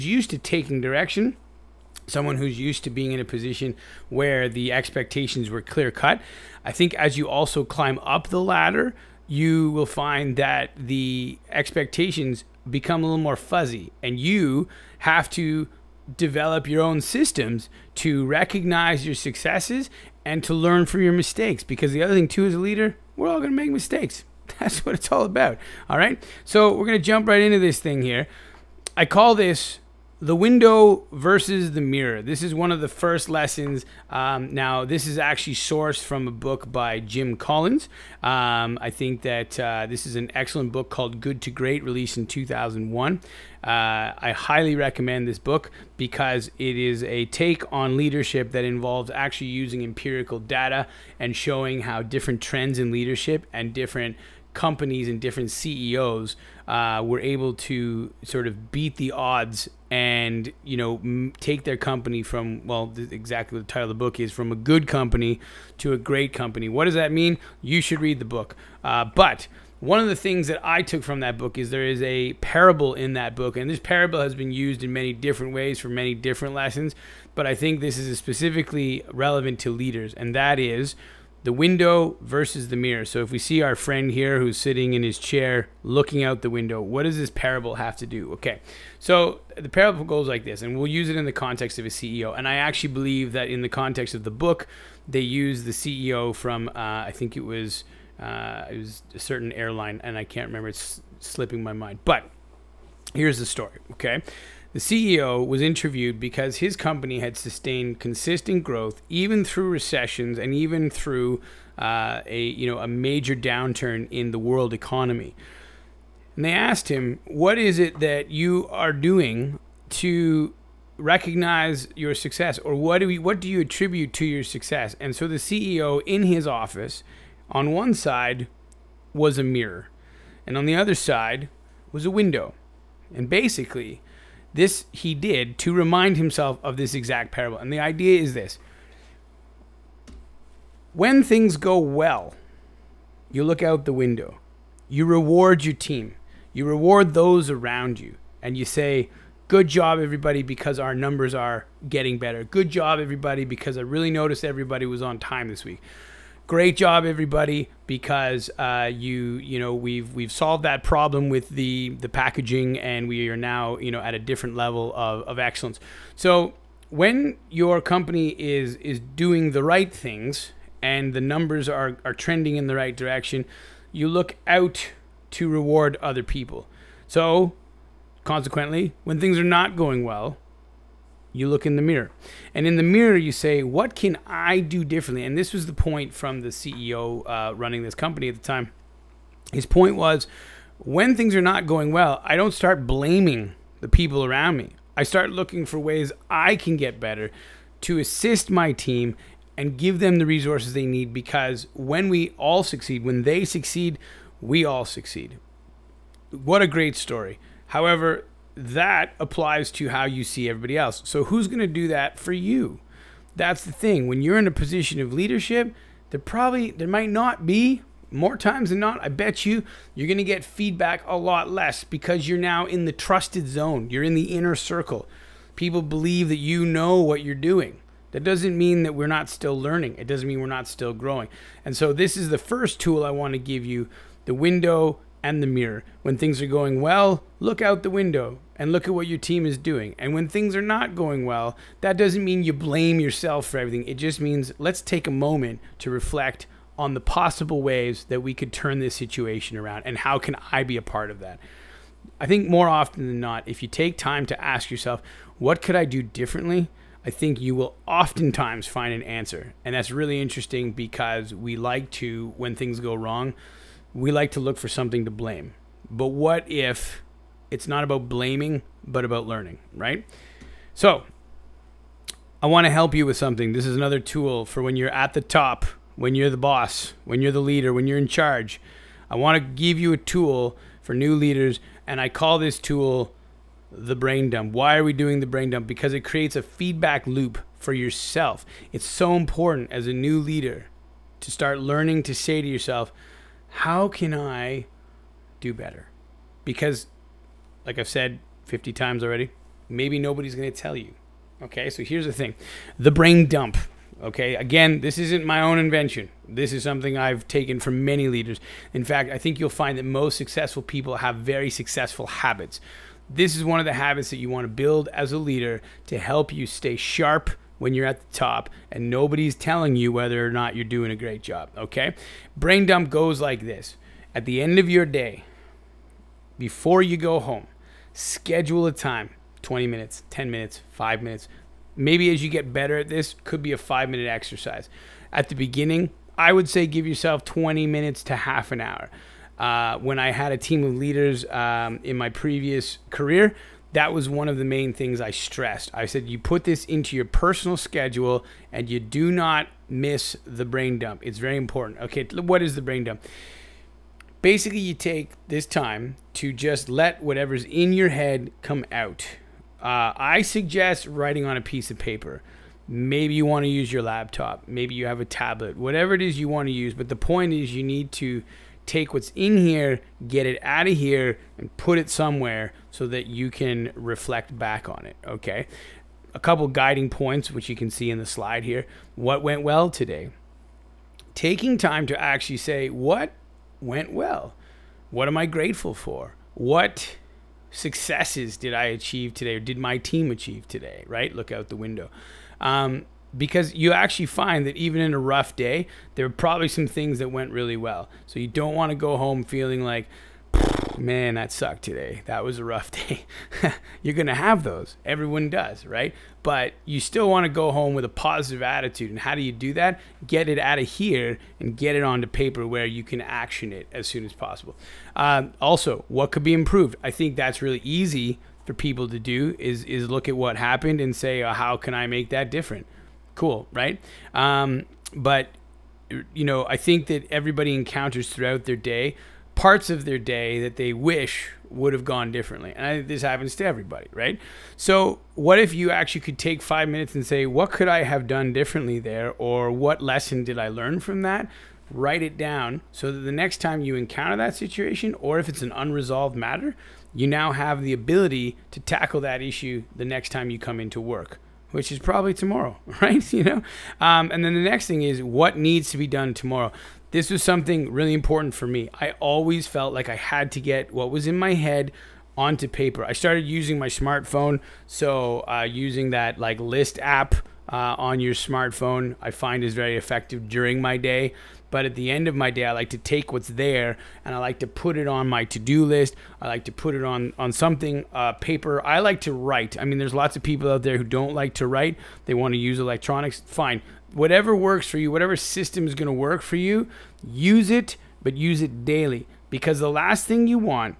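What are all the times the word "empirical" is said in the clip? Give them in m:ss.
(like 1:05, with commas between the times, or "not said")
0:49.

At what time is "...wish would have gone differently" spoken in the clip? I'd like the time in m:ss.
7:10.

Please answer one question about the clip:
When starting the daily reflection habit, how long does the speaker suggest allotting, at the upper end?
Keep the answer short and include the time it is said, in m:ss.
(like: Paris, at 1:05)
Half an hour, at 5:38.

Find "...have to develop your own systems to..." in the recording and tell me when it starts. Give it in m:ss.
0:14.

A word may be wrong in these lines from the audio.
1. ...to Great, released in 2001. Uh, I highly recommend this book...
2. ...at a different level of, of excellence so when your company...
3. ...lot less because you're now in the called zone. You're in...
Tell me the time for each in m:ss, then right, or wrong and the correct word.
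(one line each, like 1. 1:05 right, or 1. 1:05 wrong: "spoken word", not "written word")
1. 0:41 right
2. 2:44 right
3. 3:41 wrong: "trusted", not "called".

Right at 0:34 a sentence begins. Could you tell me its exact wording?
Um, now, this is actually sourced from a book by Jim Collins.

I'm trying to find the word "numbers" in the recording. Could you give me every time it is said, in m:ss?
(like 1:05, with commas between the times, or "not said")
2:30, 2:51.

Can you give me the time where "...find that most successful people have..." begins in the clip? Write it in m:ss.
5:09.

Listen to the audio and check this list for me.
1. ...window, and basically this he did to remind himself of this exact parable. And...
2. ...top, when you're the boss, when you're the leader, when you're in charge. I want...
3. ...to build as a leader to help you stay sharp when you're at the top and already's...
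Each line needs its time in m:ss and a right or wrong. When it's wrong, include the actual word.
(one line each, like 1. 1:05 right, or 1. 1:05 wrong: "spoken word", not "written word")
1. 2:12 right
2. 4:35 right
3. 5:14 wrong: "nobody", not "already".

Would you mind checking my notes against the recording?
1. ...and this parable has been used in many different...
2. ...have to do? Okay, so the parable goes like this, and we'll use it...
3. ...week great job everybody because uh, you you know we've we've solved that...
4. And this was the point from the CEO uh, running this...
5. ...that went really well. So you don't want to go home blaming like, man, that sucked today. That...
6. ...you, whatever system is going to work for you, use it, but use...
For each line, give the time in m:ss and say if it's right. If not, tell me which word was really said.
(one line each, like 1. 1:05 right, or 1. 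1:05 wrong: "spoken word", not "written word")
1. 1:13 right
2. 1:27 right
3. 2:35 right
4. 3:05 right
5. 6:36 wrong: "feeling", not "blaming"
6. 8:04 right.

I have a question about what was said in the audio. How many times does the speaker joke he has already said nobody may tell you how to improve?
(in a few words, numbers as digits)
50.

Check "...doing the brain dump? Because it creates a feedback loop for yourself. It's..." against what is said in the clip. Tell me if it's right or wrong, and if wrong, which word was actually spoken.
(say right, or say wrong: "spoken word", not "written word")
right.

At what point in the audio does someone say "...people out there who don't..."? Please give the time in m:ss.
8:00.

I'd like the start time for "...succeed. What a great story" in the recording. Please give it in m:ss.
3:24.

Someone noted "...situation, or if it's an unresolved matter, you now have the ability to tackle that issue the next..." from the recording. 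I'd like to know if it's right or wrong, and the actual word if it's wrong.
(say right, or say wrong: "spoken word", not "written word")
right.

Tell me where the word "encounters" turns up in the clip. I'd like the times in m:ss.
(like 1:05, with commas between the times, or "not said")
7:07, 7:23.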